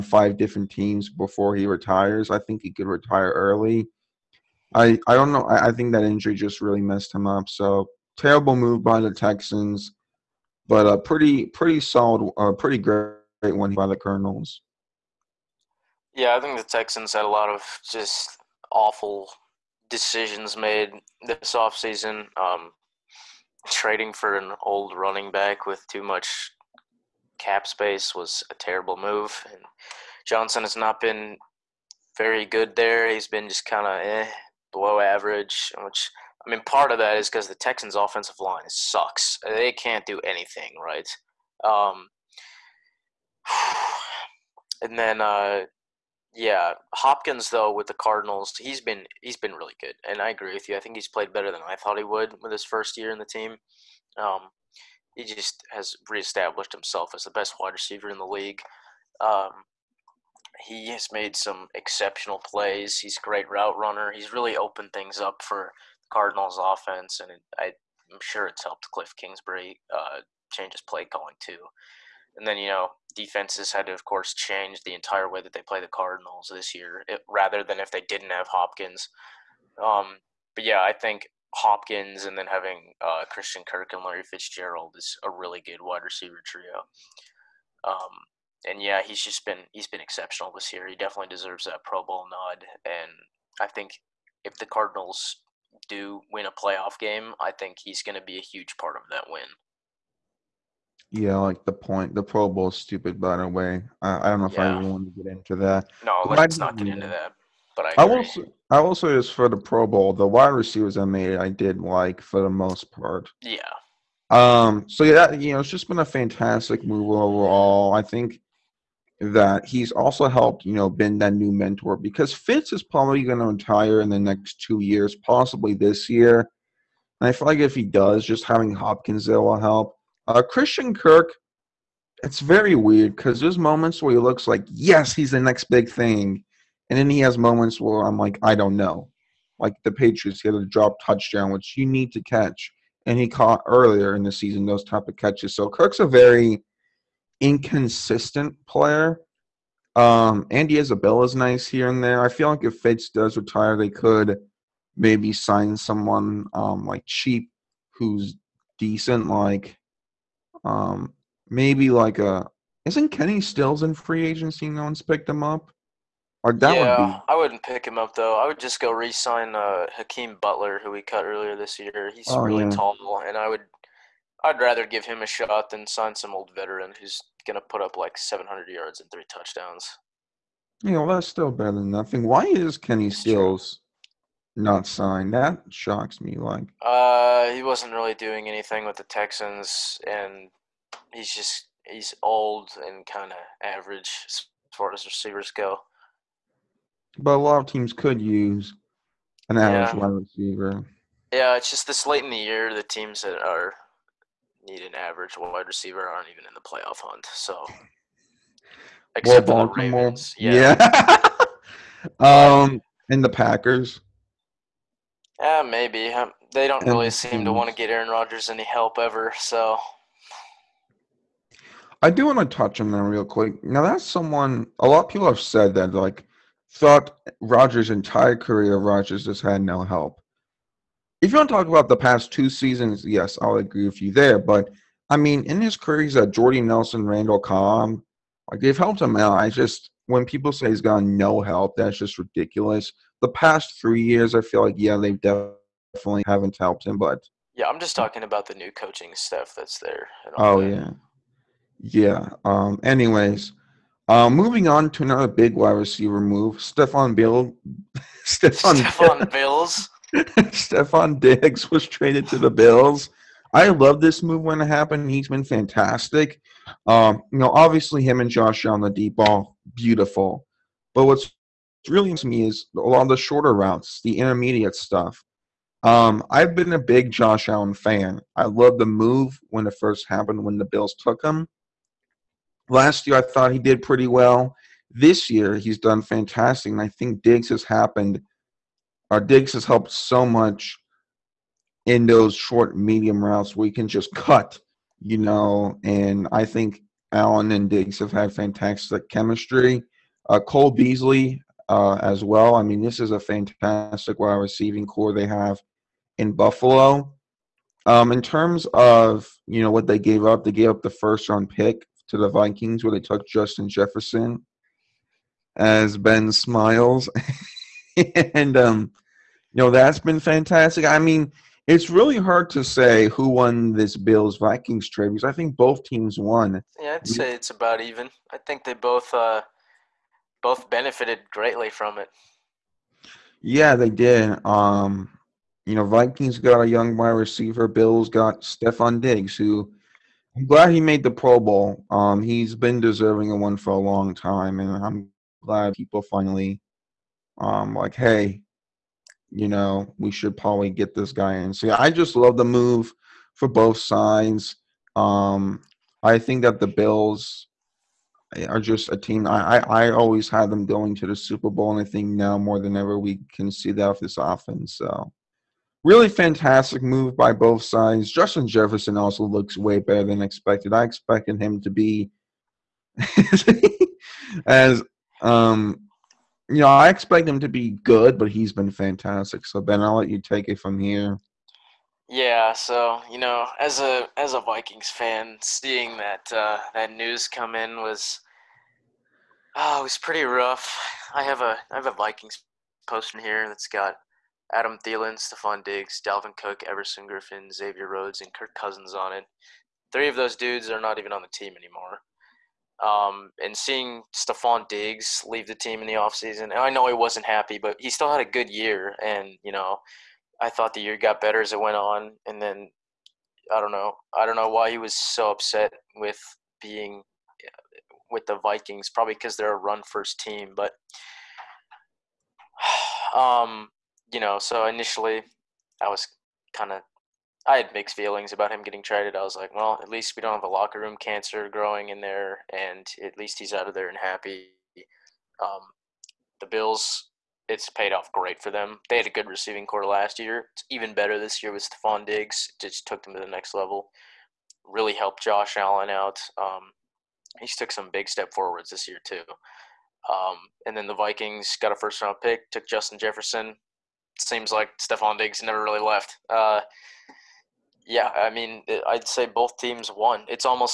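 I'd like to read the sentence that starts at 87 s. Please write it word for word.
Um, and yeah, he's just been he's been exceptional this year.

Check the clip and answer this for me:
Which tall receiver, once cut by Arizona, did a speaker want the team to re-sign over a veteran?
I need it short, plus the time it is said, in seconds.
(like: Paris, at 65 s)
Hakeem Butler, at 169 s.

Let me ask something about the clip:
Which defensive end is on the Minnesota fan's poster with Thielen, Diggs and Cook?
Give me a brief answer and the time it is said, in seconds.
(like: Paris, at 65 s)
Everson Griffen, at 396 s.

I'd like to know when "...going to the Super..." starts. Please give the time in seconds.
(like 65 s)
360 s.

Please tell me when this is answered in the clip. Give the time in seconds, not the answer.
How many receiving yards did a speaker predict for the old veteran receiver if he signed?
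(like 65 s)
178 s.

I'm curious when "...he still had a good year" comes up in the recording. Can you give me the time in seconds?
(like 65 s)
407 s.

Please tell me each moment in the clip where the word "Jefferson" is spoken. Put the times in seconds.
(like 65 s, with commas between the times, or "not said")
313 s, 368 s, 452 s.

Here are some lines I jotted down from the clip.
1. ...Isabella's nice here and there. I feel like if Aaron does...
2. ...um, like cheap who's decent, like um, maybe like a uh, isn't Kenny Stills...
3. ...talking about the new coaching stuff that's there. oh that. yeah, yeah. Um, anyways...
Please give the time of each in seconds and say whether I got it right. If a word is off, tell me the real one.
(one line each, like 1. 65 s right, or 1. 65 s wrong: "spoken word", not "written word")
1. 150 s wrong: "Fitz", not "Aaron"
2. 156 s right
3. 247 s right.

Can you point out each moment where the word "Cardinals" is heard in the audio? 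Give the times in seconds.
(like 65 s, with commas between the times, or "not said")
47 s, 66 s, 75 s, 94 s.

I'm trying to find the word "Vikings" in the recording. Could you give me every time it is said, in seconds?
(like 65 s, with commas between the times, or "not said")
312 s, 324 s, 335 s, 384 s, 391 s, 418 s, 450 s.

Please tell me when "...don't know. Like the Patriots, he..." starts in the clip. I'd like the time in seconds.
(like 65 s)
138 s.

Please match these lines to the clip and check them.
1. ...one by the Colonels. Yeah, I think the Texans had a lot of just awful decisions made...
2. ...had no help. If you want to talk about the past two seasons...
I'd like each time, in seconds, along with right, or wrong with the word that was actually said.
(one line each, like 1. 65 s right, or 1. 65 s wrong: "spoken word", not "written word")
1. 13 s right
2. 229 s right.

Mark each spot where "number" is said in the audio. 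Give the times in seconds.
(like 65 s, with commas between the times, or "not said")
not said.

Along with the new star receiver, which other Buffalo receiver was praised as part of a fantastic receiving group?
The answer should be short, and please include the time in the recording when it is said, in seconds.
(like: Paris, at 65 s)
Cole Beasley, at 300 s.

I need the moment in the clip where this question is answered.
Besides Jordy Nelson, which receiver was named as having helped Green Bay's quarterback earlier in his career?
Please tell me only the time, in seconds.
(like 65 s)
237 s.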